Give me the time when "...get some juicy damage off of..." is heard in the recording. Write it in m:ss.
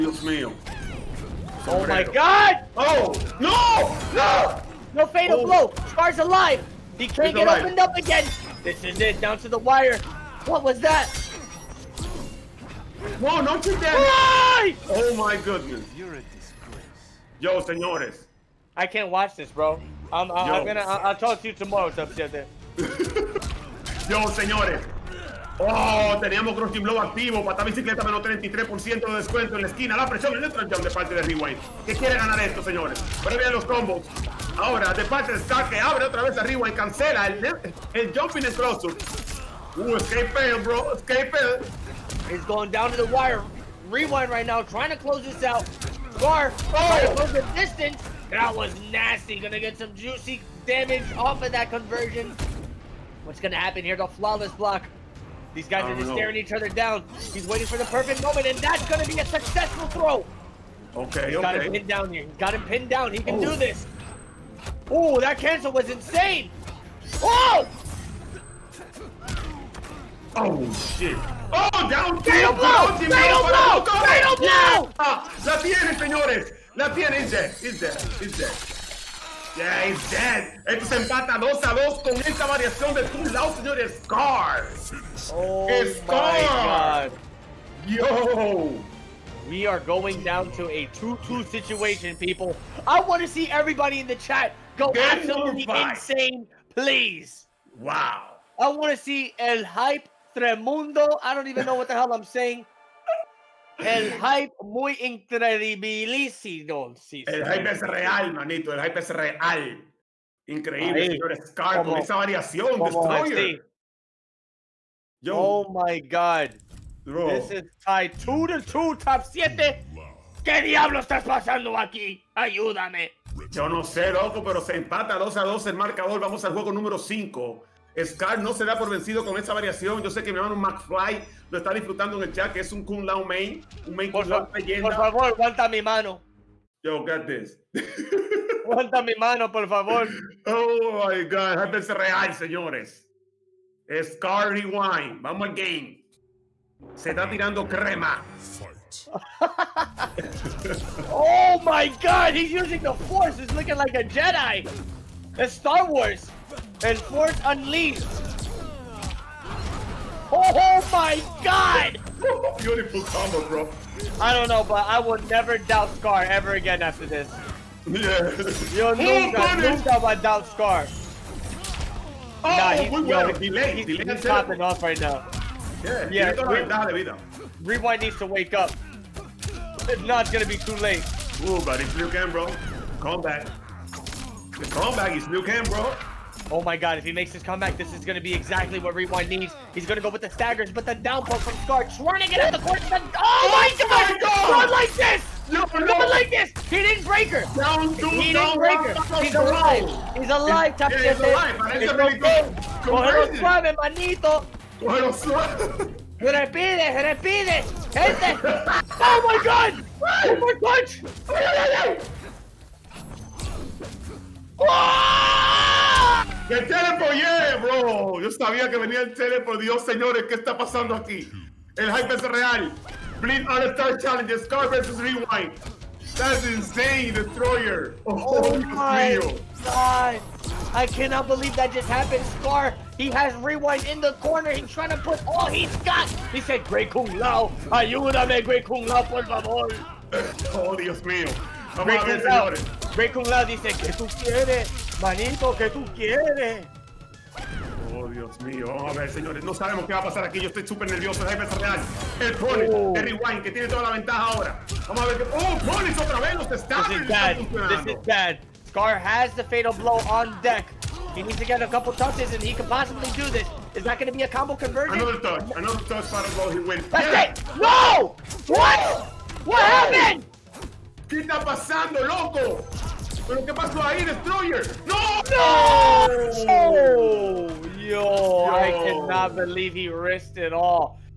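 0:49.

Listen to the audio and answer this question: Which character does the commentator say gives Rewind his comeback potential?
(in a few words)
Liu Kang.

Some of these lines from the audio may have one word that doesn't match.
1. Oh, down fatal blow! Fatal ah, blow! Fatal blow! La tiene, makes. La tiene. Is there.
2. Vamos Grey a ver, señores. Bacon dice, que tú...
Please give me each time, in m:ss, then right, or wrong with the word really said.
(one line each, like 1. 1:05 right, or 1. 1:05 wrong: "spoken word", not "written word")
1. 1:11 wrong: "señores", not "makes"
2. 4:01 right.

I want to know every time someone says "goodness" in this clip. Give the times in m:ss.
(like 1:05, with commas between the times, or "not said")
0:15.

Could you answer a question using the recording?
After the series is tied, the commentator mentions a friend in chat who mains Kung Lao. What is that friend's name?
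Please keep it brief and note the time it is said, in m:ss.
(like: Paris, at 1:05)
McFly, at 2:10.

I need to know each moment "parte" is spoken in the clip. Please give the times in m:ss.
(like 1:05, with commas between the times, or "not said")
0:30, 0:35.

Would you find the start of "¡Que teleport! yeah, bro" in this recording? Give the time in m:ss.
3:36.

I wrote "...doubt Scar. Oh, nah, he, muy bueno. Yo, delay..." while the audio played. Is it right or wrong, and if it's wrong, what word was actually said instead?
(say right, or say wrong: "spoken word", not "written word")
right.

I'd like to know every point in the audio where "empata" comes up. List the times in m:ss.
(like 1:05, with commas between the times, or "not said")
1:20, 2:04.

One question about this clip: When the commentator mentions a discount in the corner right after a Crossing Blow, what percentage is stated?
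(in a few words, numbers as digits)
33%.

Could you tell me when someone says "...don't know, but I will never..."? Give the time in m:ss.
2:44.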